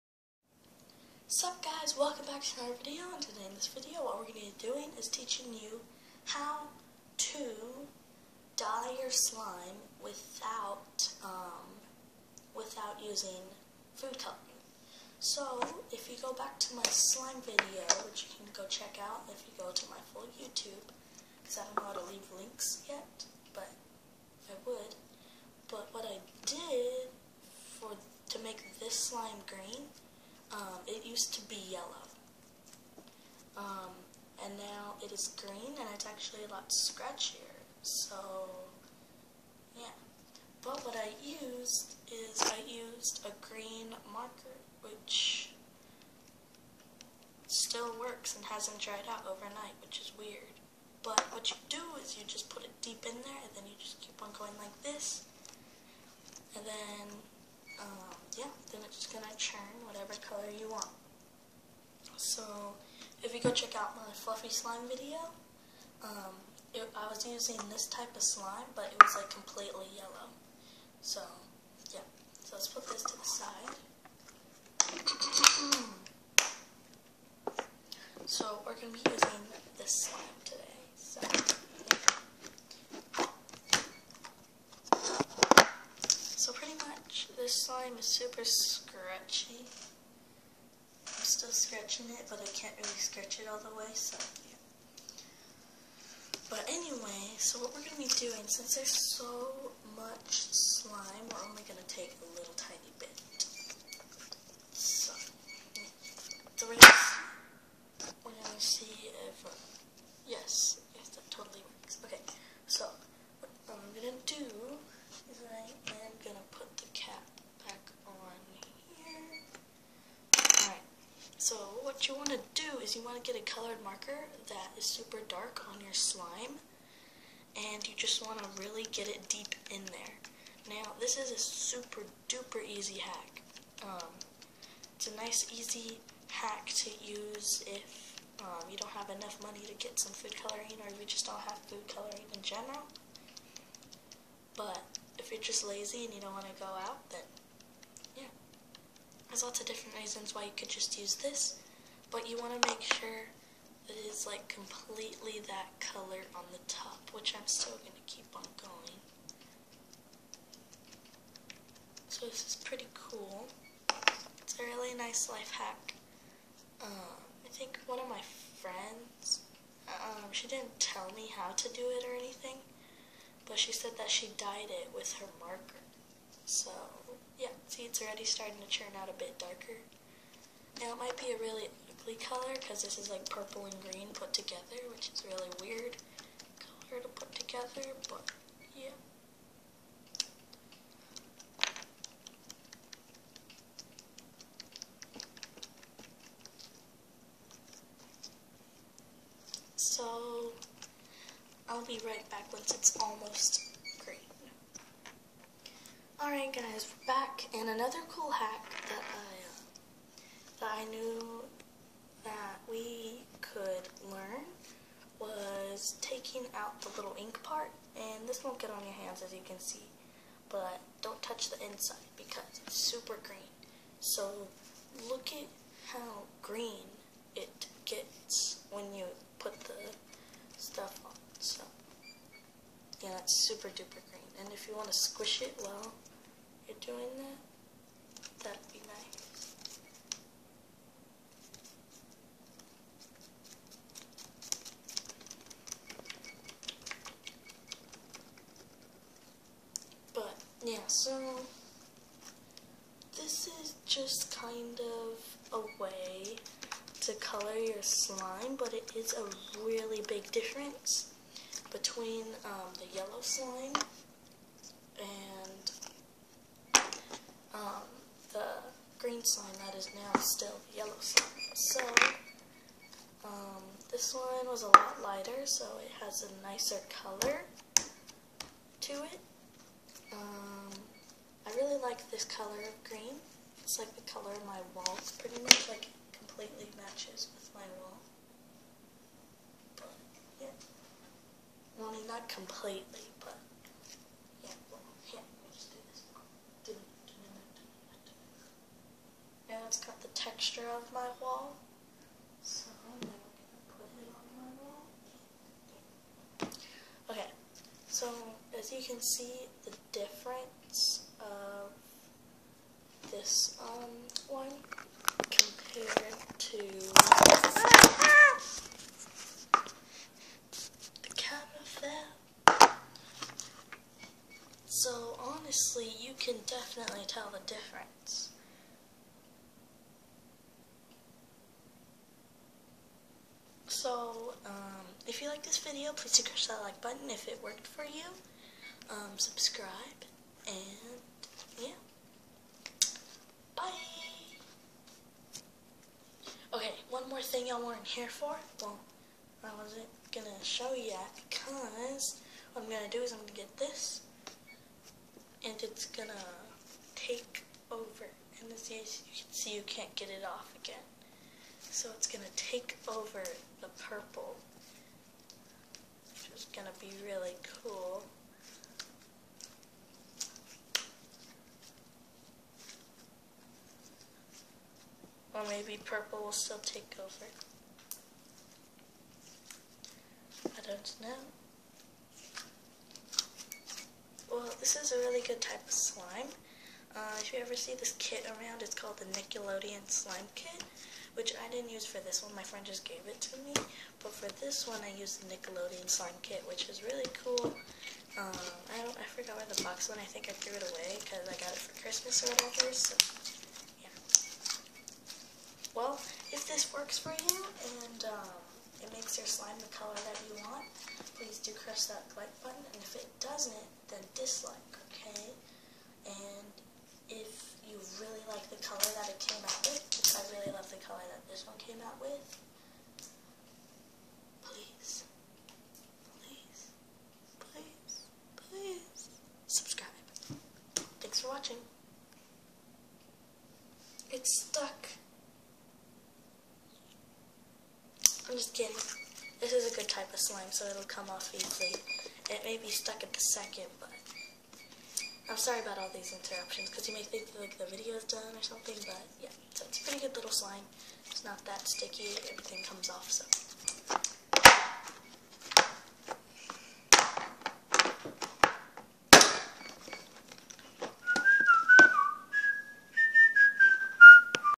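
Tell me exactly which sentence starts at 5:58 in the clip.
And as you can see, you can't get it off again.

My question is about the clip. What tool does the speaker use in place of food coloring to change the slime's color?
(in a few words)
Green marker.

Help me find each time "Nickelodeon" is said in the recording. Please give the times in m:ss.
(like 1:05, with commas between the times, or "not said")
6:29, 6:35.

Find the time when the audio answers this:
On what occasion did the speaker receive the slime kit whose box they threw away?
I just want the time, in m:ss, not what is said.
6:41.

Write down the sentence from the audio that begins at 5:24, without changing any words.
So honestly, you can definitely tell the difference.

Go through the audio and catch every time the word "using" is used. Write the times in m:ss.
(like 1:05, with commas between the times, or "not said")
0:13, 1:07.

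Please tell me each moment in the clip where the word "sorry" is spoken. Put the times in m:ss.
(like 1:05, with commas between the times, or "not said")
7:25.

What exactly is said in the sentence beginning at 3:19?
So, I'll be right back once it's almost green.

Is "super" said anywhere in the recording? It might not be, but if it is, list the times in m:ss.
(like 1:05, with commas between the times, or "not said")
1:28, 2:04, 2:11, 3:42, 3:53.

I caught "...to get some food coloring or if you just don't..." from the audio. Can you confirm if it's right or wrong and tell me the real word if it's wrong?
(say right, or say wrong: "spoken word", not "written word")
right.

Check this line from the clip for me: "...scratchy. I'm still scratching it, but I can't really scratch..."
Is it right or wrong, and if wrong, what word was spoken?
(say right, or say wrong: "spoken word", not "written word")
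right.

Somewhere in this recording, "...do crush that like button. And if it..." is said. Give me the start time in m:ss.
6:51.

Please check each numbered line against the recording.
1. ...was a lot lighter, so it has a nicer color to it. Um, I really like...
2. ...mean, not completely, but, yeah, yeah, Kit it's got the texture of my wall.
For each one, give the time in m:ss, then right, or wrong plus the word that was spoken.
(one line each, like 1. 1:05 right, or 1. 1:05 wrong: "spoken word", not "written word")
1. 4:34 right
2. 4:51 wrong: "Now", not "Kit".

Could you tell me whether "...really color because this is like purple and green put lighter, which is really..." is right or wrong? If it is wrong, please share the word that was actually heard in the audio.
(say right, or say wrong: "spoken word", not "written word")
wrong: "together", not "lighter".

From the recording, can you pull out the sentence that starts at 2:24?
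But if you're just lazy and you don't want to go out, then yeah.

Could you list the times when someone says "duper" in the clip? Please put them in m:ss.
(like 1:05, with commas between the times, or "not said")
2:12, 3:53.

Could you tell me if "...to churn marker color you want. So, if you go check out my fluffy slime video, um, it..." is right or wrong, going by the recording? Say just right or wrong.
wrong.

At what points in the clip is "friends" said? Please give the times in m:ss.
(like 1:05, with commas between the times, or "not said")
2:48, 6:32.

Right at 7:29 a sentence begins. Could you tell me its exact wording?
So it's a pretty good little slime.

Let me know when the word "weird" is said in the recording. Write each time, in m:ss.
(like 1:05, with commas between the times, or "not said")
0:50, 3:05.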